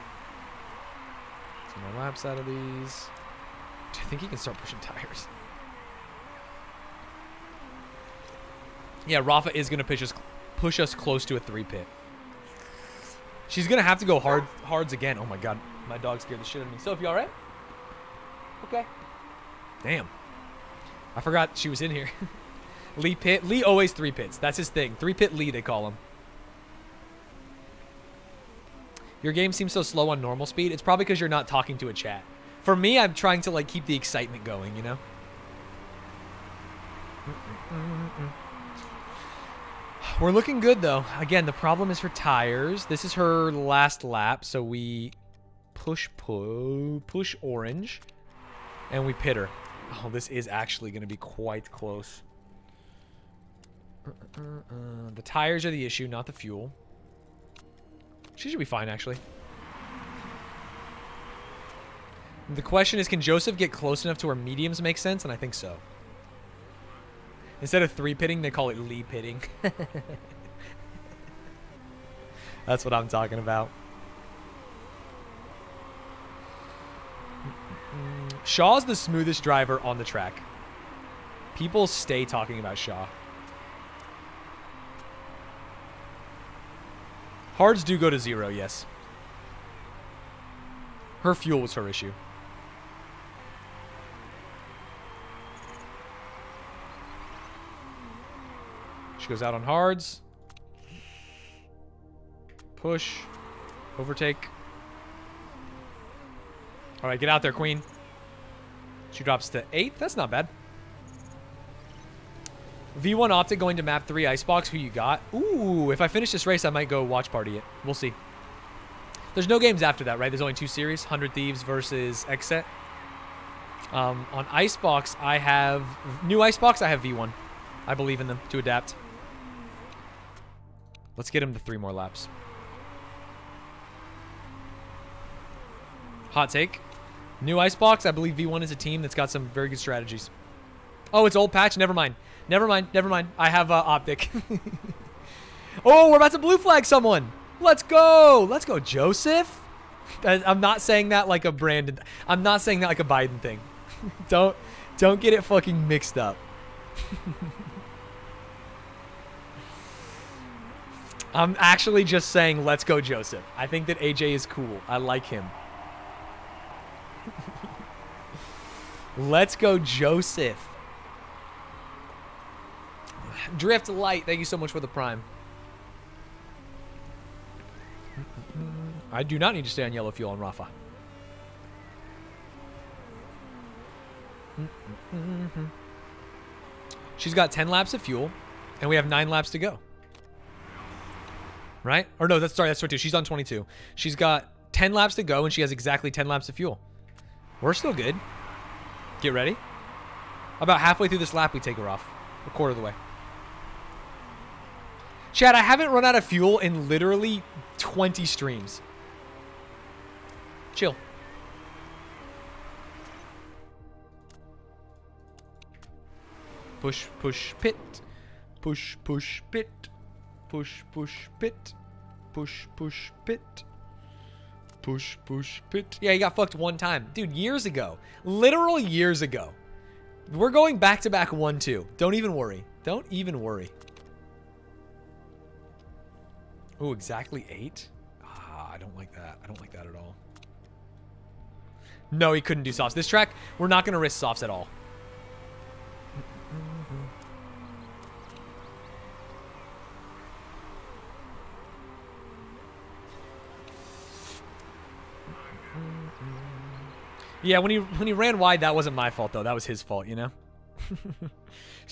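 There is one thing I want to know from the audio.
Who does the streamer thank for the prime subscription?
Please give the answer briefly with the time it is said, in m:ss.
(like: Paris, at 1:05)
Drift Light, at 2:53.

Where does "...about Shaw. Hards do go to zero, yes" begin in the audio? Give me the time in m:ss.
1:22.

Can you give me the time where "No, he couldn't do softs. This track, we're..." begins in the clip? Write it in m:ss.
4:02.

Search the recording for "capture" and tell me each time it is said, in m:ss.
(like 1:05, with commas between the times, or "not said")
not said.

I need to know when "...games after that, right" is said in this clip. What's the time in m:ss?
1:59.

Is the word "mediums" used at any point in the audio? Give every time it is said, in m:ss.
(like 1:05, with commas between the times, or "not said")
1:04.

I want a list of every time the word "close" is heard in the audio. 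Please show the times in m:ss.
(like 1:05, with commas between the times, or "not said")
0:10, 0:51, 1:03.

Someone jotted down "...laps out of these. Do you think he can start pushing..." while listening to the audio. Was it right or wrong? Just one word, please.
right.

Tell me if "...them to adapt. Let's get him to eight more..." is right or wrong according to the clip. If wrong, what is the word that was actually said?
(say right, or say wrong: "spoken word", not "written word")
wrong: "three", not "eight".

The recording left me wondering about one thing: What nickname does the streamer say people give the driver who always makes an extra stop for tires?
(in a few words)
Three Pit Lee.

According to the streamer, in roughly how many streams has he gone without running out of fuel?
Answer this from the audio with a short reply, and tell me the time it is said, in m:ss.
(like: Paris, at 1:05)
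20, at 3:27.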